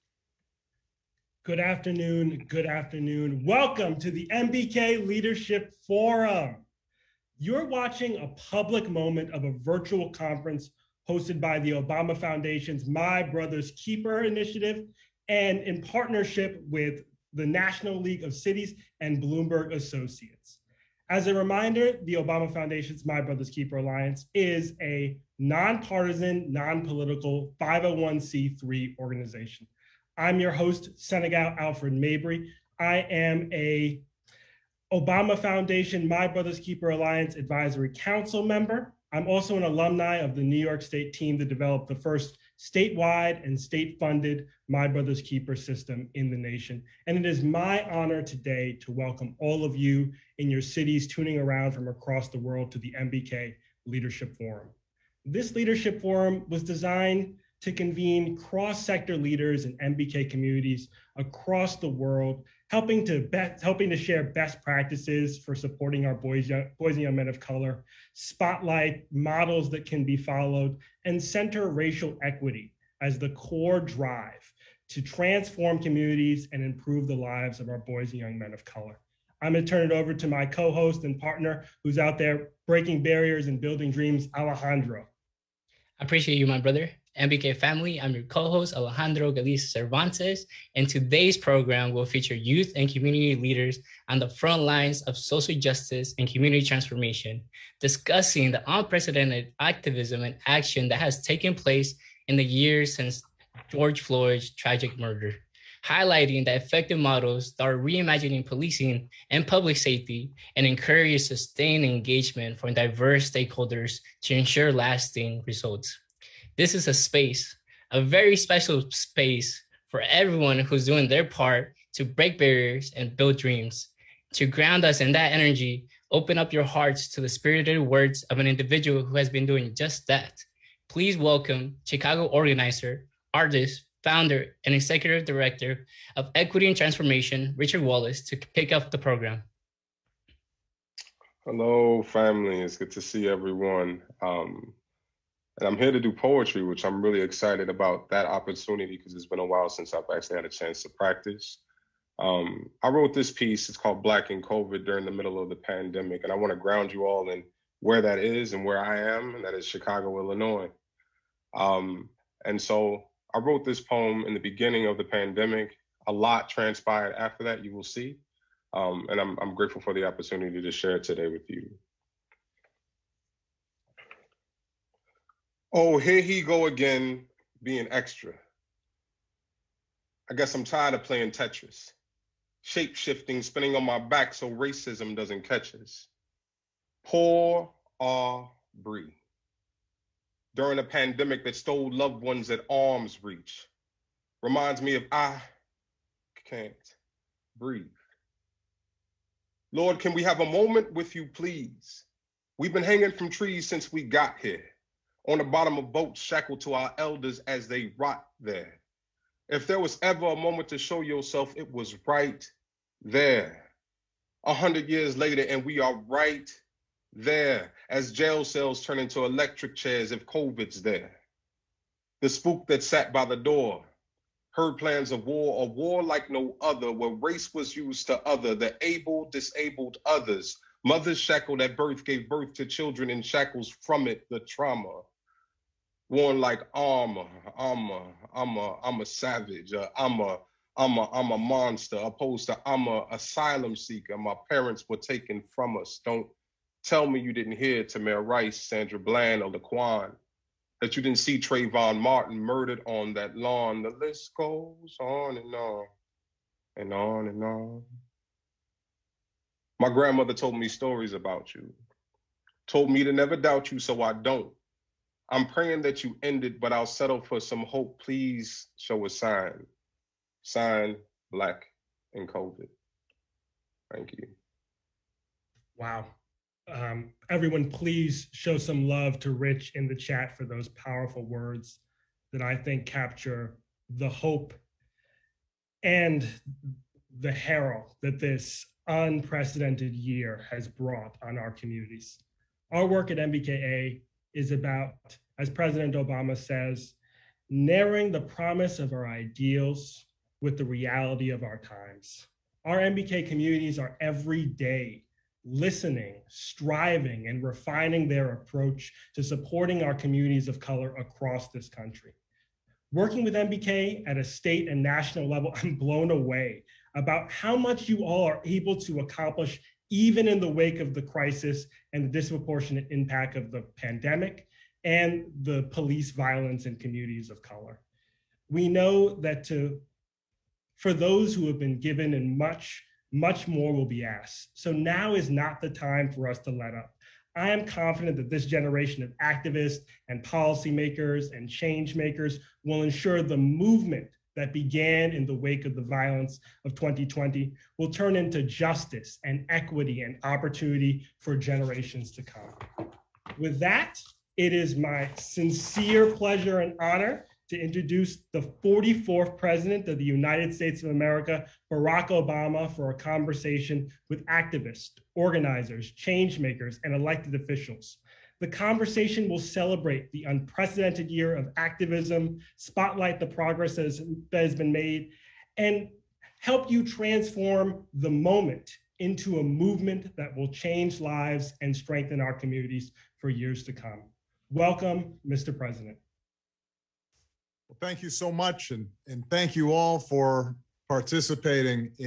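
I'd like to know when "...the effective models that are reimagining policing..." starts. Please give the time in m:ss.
1:46.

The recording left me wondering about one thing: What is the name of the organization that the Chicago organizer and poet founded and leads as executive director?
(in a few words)
Equity and Transformation.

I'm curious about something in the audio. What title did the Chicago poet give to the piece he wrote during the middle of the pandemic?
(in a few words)
Black in COVID.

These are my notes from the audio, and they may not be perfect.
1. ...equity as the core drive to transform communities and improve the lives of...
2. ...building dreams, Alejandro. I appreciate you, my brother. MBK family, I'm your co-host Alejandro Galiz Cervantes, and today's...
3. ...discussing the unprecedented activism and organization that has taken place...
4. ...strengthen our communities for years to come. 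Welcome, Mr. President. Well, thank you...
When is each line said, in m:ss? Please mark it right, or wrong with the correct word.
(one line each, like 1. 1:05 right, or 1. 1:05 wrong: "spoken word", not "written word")
1. 1:12 right
2. 1:23 right
3. 1:37 wrong: "action", not "organization"
4. 6:21 right.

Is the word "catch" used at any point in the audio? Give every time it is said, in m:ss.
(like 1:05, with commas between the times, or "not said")
3:05.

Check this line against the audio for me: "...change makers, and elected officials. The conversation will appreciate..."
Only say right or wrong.
wrong.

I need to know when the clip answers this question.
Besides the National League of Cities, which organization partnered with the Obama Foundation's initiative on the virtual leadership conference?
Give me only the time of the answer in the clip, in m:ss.
0:19.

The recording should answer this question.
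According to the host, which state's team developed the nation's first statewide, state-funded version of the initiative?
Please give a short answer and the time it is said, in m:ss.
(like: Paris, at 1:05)
New York, at 0:40.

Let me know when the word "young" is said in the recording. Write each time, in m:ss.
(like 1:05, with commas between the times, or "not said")
1:07, 1:18.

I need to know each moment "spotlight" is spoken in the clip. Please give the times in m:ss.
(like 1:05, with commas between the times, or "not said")
1:08, 6:12.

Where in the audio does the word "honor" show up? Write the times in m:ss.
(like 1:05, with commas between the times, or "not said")
0:47, 5:56.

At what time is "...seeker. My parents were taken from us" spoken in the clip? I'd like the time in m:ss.
4:03.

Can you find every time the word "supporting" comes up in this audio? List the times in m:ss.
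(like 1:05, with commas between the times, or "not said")
1:05, 5:09.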